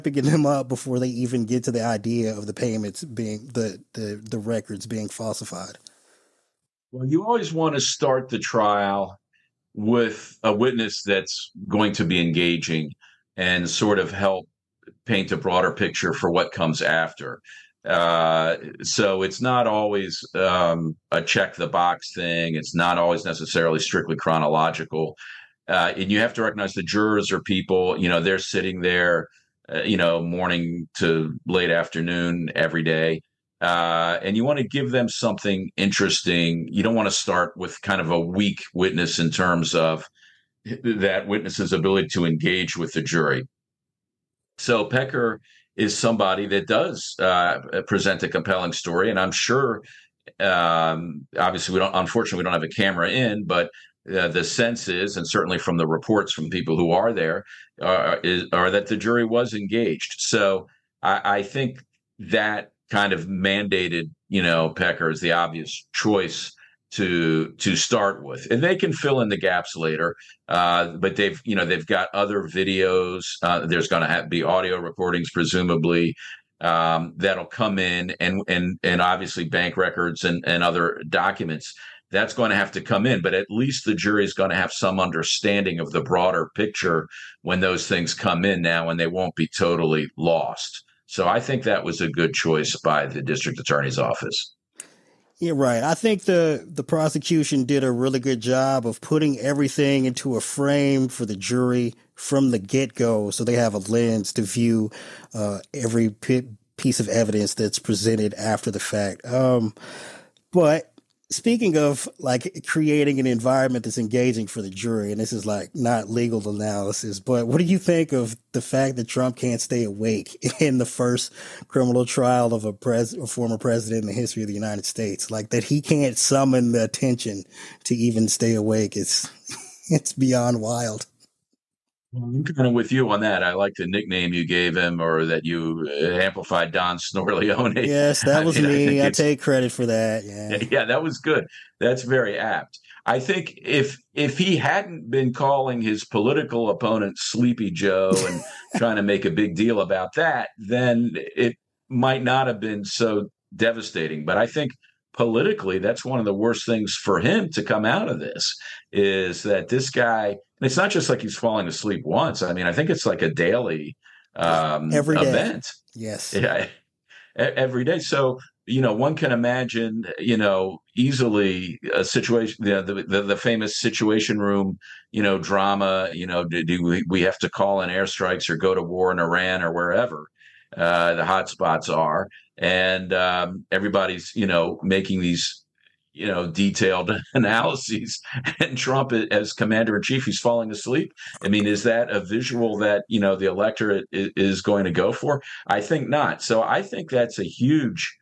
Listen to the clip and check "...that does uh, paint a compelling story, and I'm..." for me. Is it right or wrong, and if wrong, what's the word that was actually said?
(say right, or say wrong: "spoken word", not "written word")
wrong: "present", not "paint".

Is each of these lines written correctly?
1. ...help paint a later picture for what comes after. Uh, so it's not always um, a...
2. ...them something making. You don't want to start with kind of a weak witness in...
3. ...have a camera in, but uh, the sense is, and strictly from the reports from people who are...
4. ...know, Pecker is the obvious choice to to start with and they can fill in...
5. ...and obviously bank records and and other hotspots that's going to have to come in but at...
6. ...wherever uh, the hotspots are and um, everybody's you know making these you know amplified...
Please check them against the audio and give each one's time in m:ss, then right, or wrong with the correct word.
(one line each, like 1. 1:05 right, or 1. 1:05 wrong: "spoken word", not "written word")
1. 0:14 wrong: "broader", not "later"
2. 0:34 wrong: "interesting", not "making"
3. 0:52 wrong: "certainly", not "strictly"
4. 1:04 right
5. 1:18 wrong: "documents", not "hotspots"
6. 2:59 wrong: "detailed", not "amplified".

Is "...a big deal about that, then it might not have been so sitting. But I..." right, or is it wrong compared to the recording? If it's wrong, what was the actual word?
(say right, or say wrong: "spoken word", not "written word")
wrong: "devastating", not "sitting".